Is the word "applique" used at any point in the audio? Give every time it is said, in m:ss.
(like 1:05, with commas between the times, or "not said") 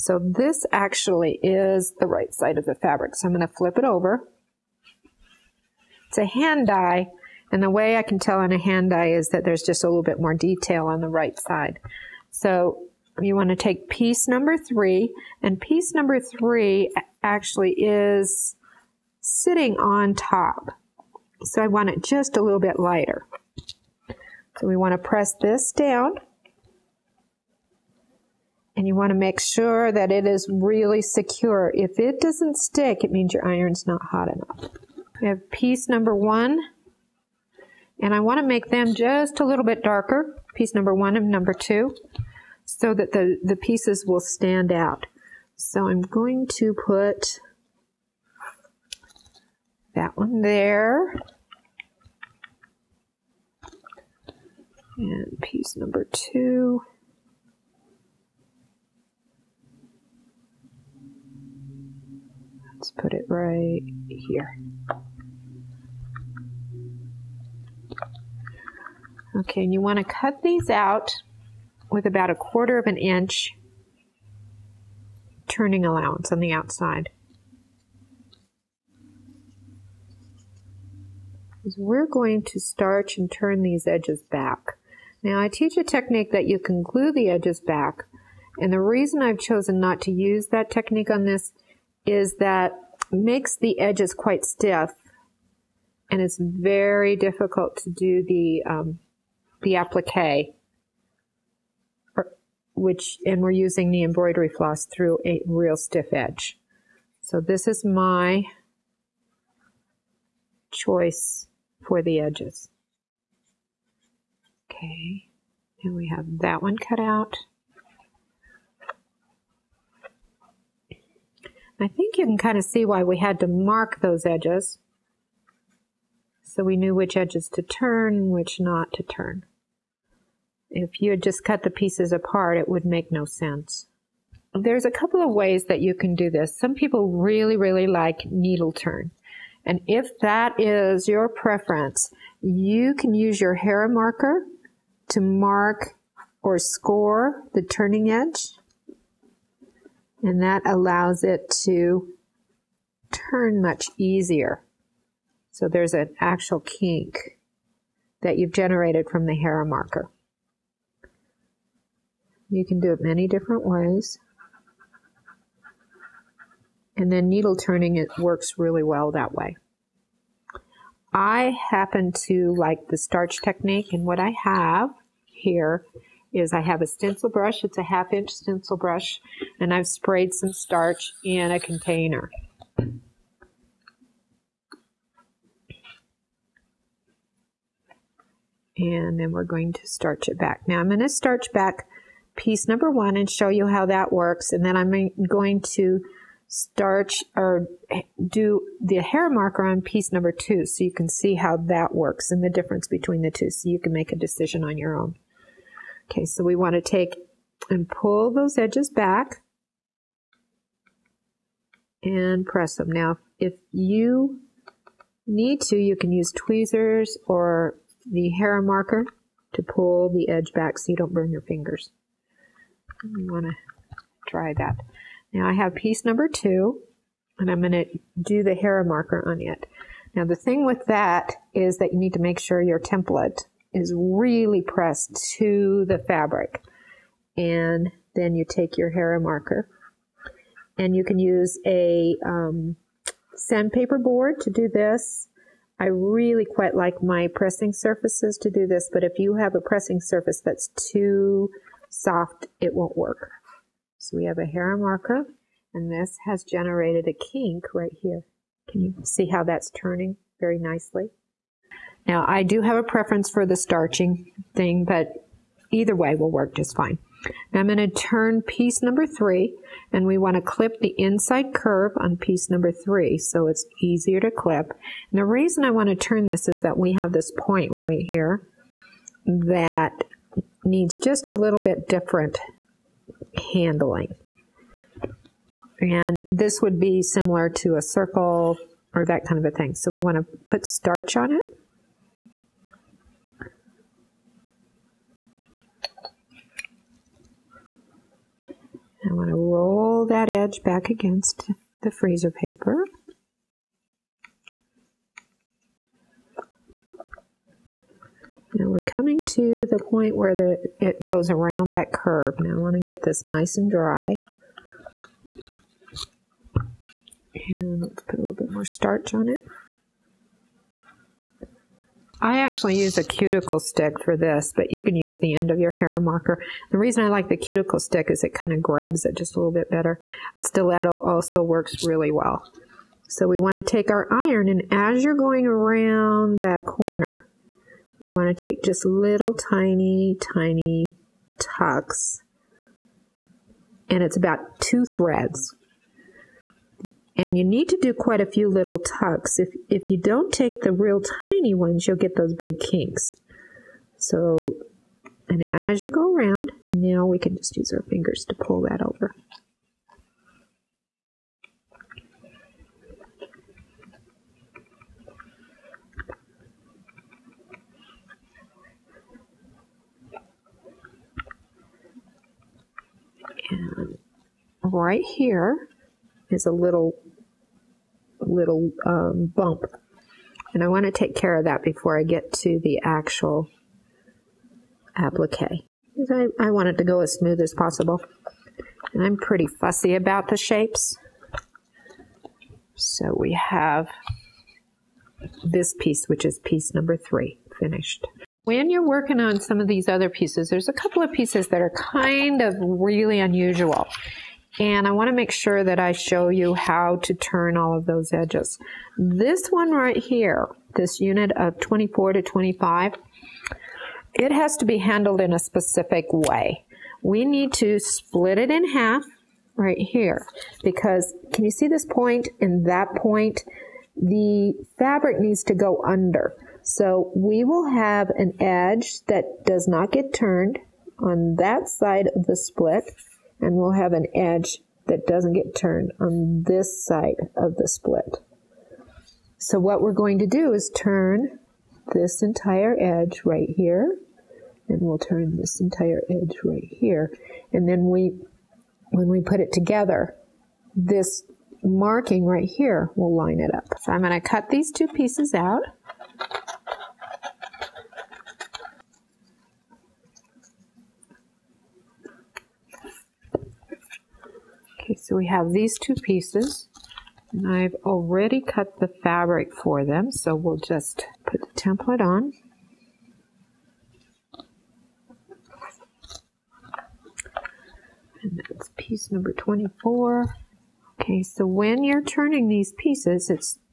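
1:39, 6:24.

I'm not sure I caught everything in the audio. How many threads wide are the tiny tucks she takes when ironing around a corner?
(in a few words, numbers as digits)
2.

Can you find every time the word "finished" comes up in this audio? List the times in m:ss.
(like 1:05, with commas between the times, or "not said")
6:37.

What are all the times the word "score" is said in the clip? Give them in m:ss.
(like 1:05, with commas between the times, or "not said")
2:26.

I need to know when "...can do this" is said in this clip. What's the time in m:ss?
2:15.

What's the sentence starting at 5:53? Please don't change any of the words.
So, and as you go around, now we can just use our fingers to pull that over.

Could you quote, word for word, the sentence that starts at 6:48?
This one right here, this unit of 24 to 25, it has to be handled in a specific way.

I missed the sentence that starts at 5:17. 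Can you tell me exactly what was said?
And let's put a little bit more starch on it.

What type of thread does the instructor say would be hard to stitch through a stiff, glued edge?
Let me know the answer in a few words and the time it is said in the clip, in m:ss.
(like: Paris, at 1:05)
embroidery floss, at 1:44.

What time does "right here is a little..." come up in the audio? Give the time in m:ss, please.
6:14.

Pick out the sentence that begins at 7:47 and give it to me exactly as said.
And I've already cut the fabric for them, so we'll just put the template on.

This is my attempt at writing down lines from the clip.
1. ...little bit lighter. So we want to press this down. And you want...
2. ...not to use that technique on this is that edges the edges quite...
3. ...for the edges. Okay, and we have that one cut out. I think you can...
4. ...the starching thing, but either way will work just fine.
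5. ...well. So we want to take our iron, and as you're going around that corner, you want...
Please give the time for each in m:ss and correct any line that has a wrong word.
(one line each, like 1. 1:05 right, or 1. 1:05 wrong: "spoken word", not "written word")
1. 0:22 right
2. 1:29 wrong: "makes", not "edges"
3. 1:51 right
4. 4:23 right
5. 5:32 right.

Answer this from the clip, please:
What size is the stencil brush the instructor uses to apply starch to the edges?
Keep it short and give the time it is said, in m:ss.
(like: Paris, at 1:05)
half inch, at 2:57.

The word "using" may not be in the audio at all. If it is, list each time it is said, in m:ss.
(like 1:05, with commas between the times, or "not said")
1:43.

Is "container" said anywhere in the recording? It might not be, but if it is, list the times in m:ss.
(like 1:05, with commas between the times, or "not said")
3:01.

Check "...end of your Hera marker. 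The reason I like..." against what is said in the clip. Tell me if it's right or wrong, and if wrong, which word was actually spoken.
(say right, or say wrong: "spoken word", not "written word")
right.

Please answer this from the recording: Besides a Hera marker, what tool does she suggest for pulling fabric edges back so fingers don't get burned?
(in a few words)
tweezers.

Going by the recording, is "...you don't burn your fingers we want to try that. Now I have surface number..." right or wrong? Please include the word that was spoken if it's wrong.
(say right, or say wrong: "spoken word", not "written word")
wrong: "piece", not "surface".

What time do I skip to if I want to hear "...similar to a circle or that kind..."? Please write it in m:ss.
4:47.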